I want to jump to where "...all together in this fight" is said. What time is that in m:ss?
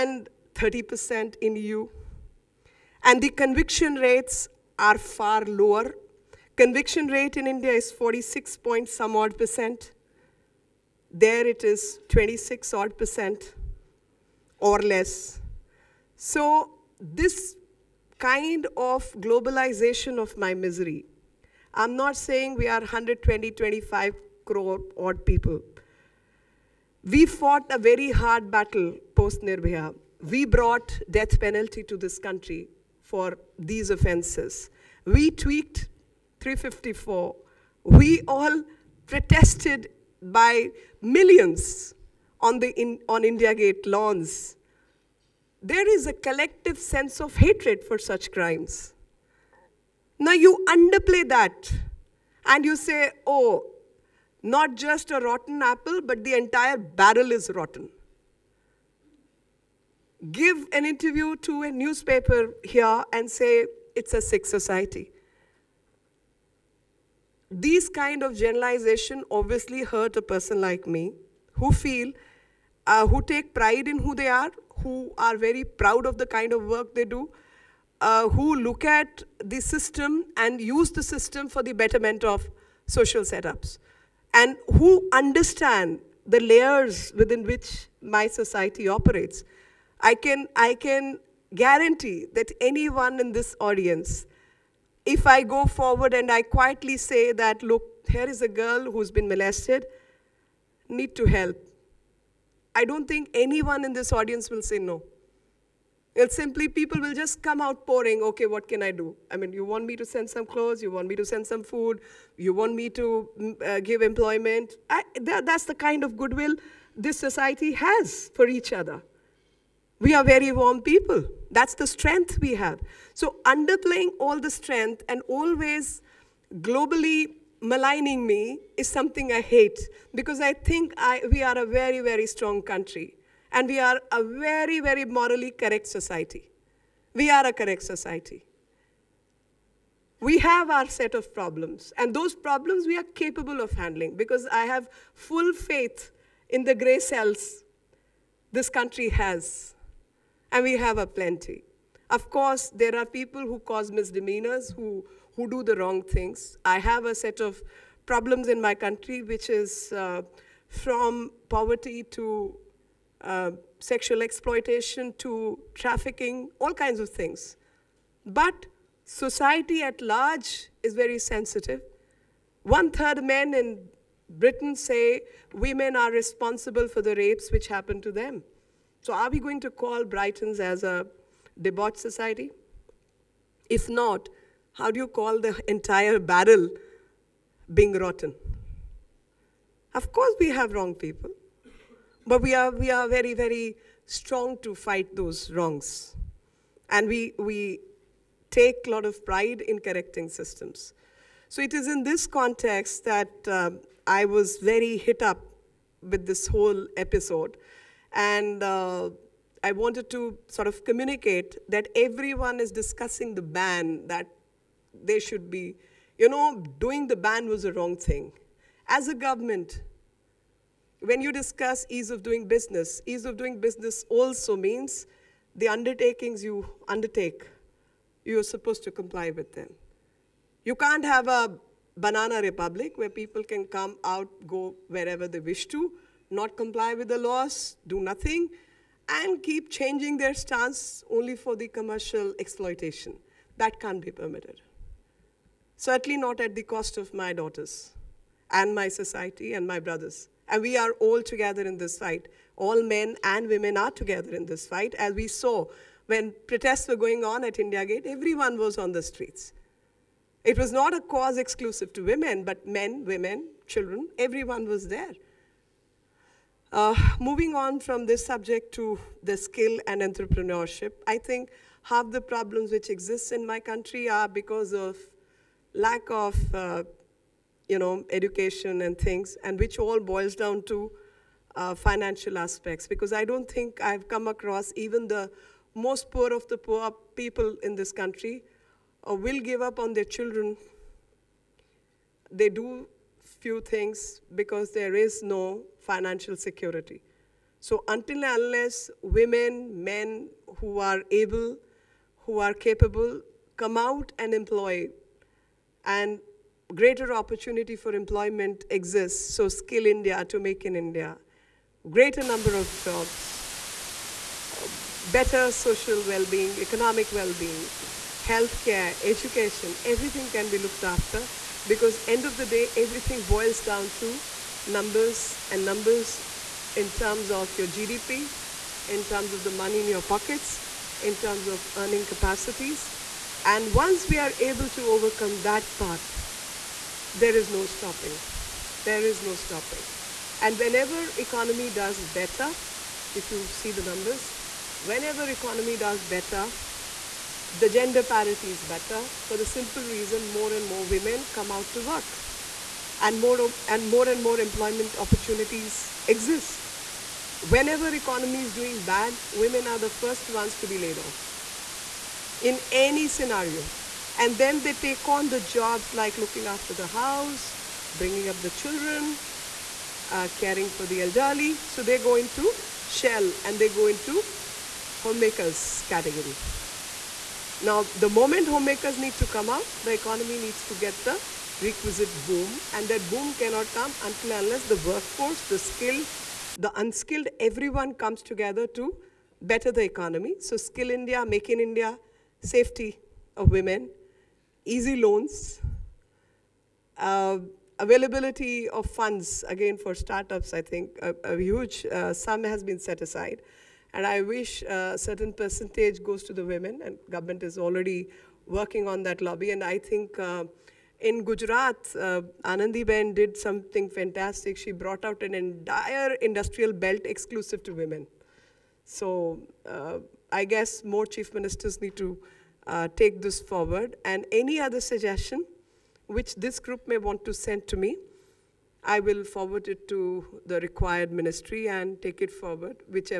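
4:10.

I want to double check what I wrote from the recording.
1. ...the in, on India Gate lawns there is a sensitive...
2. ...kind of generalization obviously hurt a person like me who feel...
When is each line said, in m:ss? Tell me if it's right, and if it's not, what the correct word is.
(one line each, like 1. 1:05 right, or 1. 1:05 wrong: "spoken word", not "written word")
1. 0:42 wrong: "collective", not "sensitive"
2. 1:07 right.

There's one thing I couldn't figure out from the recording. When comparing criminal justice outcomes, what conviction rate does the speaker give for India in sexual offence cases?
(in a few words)
46 percent.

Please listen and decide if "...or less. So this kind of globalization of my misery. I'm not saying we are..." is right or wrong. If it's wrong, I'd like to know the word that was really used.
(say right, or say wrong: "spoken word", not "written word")
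right.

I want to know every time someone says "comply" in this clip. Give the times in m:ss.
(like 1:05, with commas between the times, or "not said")
3:48, 3:56.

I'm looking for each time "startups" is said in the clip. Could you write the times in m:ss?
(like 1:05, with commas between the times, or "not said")
6:39.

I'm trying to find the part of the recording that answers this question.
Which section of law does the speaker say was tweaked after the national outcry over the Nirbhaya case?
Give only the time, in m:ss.
0:36.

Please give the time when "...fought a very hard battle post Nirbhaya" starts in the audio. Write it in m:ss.
0:27.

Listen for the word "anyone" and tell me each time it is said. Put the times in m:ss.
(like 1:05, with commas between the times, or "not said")
1:32, 1:43.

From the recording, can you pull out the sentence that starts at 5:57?
Whenever economy is doing bad, women are the first ones to be laid off in any scenario.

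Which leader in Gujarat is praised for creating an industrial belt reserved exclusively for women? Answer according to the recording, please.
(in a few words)
Anandi Ben.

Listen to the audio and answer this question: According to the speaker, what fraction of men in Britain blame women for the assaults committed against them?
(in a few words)
One third.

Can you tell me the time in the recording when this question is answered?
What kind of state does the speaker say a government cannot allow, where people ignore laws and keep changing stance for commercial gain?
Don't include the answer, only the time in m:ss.
3:51.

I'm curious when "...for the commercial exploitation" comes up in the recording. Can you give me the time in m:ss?
4:01.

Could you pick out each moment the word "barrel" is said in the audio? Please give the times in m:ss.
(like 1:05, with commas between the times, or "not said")
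0:56, 3:06.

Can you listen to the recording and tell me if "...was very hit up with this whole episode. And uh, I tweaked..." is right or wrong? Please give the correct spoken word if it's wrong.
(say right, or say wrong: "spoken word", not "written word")
wrong: "wanted", not "tweaked".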